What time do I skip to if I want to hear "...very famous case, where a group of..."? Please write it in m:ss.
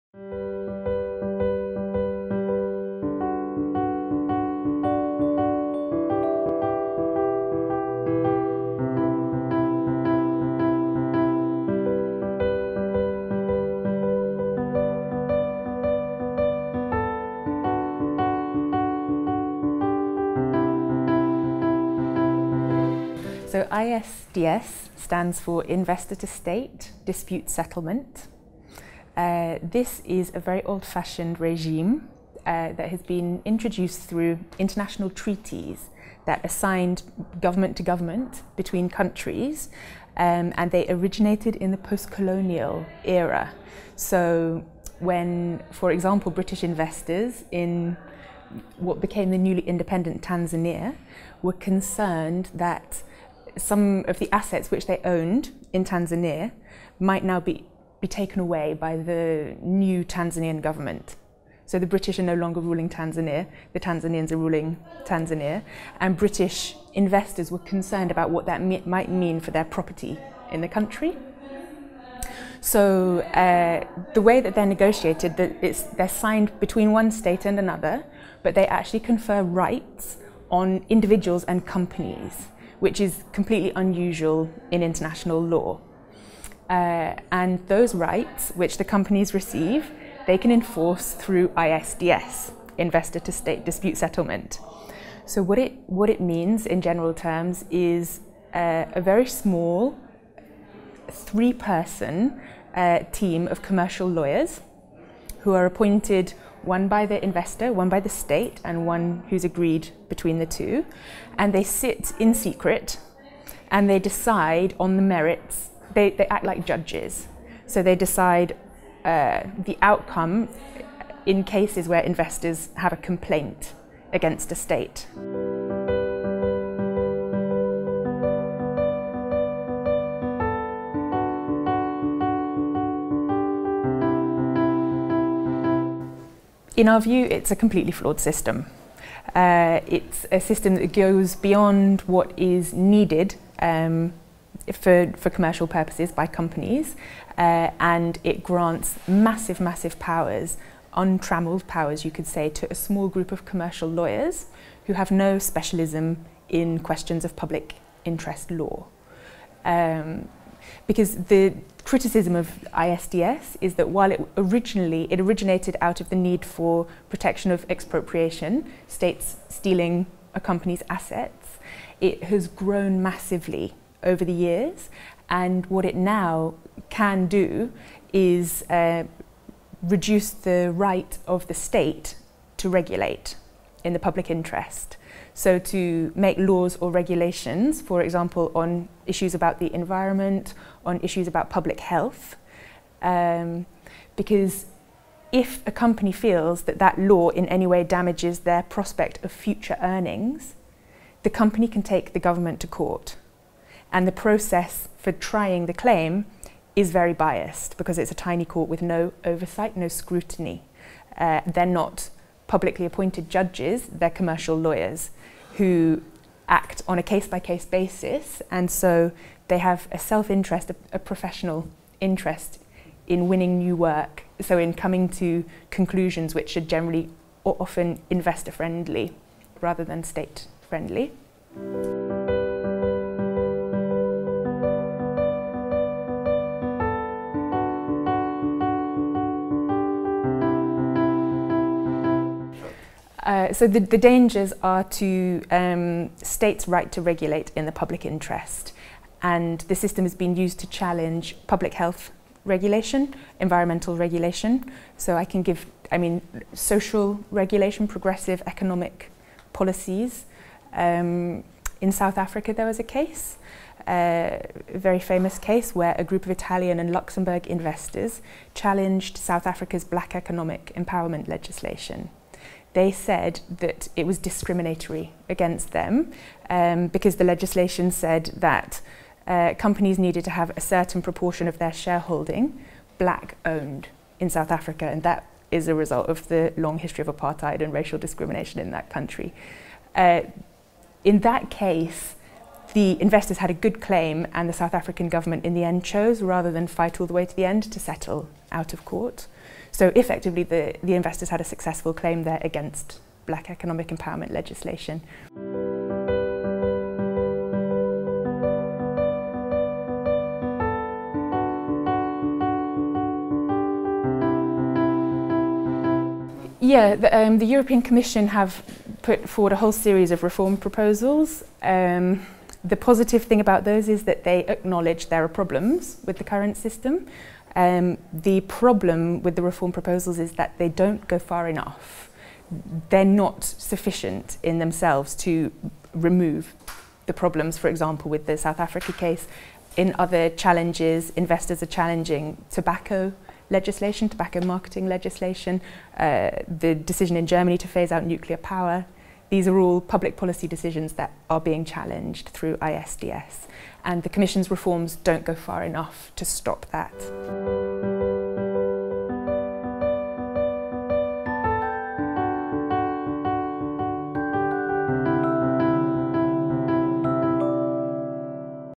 4:24.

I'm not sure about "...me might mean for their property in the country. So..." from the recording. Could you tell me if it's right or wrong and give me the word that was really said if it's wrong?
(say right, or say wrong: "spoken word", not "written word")
right.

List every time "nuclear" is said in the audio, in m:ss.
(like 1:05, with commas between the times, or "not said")
5:48.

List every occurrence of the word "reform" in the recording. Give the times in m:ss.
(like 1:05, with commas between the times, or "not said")
5:20, 5:29, 5:54.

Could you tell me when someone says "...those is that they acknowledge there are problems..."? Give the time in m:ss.
5:23.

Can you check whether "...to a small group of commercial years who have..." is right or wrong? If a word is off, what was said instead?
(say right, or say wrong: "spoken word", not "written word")
wrong: "lawyers", not "years".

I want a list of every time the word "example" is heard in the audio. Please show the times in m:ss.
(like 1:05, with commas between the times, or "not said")
0:45, 3:08, 5:37.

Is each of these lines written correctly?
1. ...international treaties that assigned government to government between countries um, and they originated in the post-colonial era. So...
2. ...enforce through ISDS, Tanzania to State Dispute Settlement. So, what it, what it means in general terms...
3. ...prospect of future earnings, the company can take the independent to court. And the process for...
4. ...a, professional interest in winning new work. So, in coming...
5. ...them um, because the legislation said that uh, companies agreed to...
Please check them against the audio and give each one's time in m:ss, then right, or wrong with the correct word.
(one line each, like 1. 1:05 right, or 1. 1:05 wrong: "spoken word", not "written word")
1. 0:34 right
2. 1:30 wrong: "Investor", not "Tanzania"
3. 3:18 wrong: "government", not "independent"
4. 3:40 right
5. 4:35 wrong: "needed", not "agreed".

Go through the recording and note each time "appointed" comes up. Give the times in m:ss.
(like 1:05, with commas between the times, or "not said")
1:45, 3:32.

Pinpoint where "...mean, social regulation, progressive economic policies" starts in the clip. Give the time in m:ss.
4:15.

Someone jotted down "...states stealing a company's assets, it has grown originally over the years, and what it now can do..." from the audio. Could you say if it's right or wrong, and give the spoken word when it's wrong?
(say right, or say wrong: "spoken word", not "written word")
wrong: "massively", not "originally".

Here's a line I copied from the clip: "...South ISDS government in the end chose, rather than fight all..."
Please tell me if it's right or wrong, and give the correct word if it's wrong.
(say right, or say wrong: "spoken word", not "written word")
wrong: "African", not "ISDS".